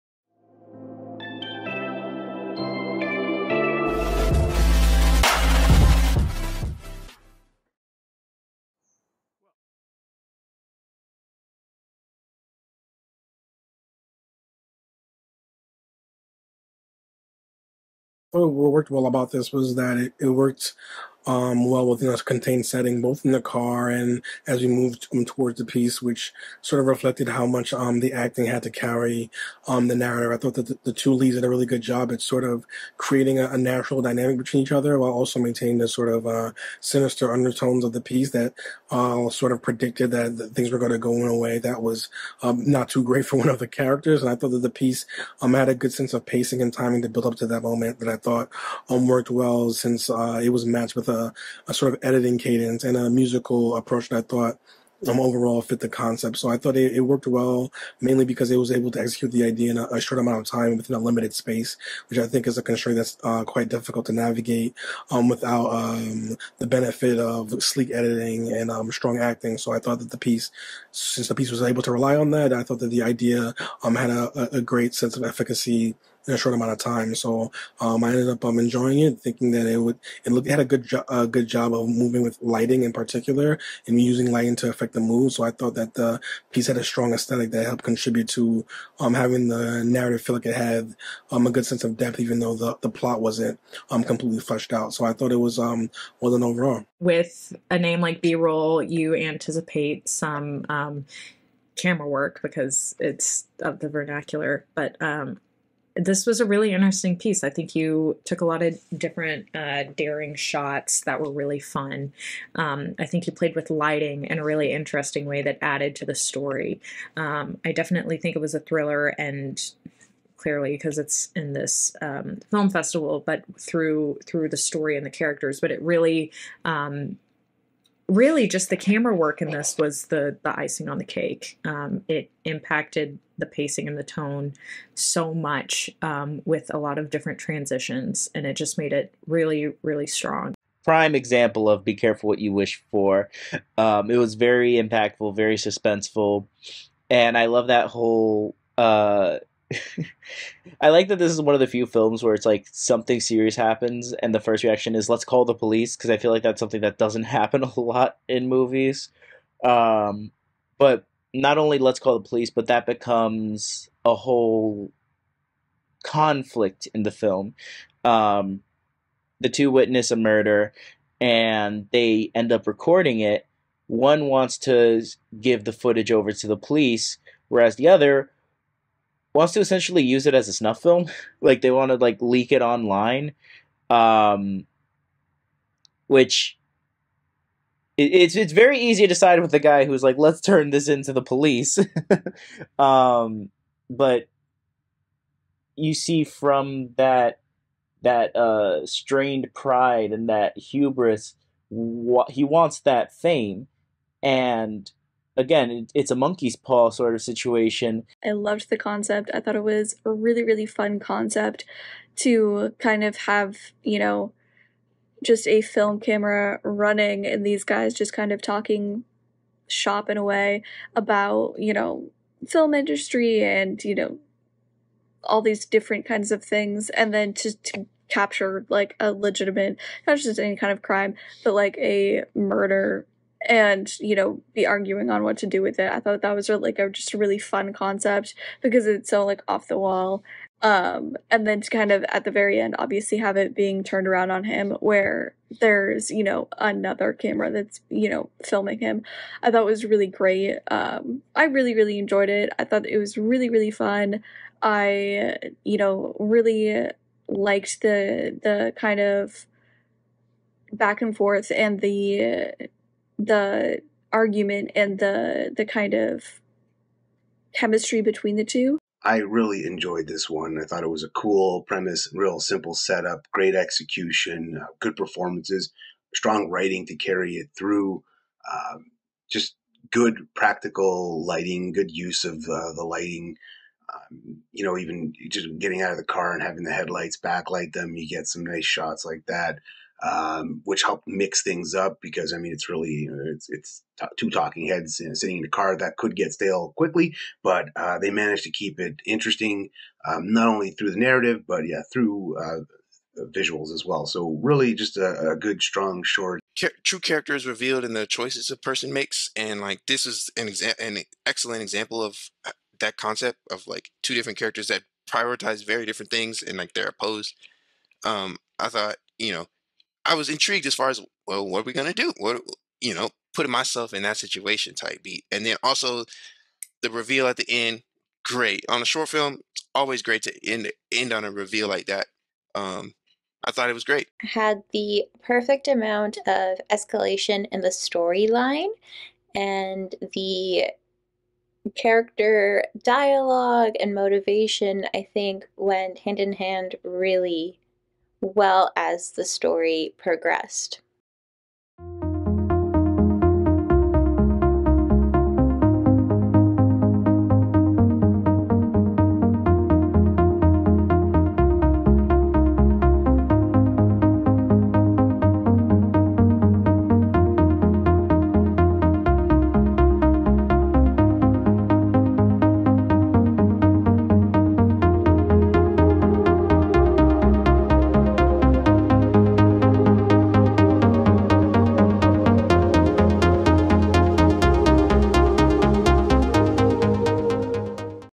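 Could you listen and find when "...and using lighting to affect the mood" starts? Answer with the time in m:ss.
1:23.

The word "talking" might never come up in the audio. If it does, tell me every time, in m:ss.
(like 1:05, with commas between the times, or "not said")
3:38, 4:54.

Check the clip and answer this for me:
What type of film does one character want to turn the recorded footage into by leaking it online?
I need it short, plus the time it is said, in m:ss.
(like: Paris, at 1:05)
Snuff film, at 3:00.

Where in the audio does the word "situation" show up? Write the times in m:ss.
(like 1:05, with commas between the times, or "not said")
3:27, 5:24.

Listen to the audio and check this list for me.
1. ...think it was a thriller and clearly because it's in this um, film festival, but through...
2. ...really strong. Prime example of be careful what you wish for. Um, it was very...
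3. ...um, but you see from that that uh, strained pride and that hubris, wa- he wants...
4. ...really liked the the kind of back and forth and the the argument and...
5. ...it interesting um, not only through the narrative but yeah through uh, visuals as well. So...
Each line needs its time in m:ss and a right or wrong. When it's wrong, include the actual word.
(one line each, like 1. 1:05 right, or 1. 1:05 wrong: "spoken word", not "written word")
1. 1:58 right
2. 2:19 right
3. 3:12 right
4. 4:16 right
5. 4:58 right.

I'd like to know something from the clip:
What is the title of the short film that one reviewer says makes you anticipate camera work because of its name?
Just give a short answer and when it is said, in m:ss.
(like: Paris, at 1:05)
B roll, at 1:38.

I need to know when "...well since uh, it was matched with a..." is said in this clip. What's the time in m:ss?
0:49.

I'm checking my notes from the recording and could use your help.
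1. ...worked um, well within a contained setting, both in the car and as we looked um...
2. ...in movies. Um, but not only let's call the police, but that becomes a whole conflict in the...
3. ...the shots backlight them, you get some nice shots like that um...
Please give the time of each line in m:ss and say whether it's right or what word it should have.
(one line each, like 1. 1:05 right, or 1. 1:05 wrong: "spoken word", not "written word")
1. 0:20 wrong: "moved", not "looked"
2. 2:38 right
3. 4:46 wrong: "headlights", not "shots".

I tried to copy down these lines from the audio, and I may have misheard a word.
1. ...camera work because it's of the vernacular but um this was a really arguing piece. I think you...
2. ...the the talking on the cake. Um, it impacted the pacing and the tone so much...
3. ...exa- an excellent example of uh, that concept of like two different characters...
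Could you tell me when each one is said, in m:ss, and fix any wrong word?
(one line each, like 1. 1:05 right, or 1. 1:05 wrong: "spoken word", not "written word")
1. 1:41 wrong: "interesting", not "arguing"
2. 2:10 wrong: "icing", not "talking"
3. 5:10 right.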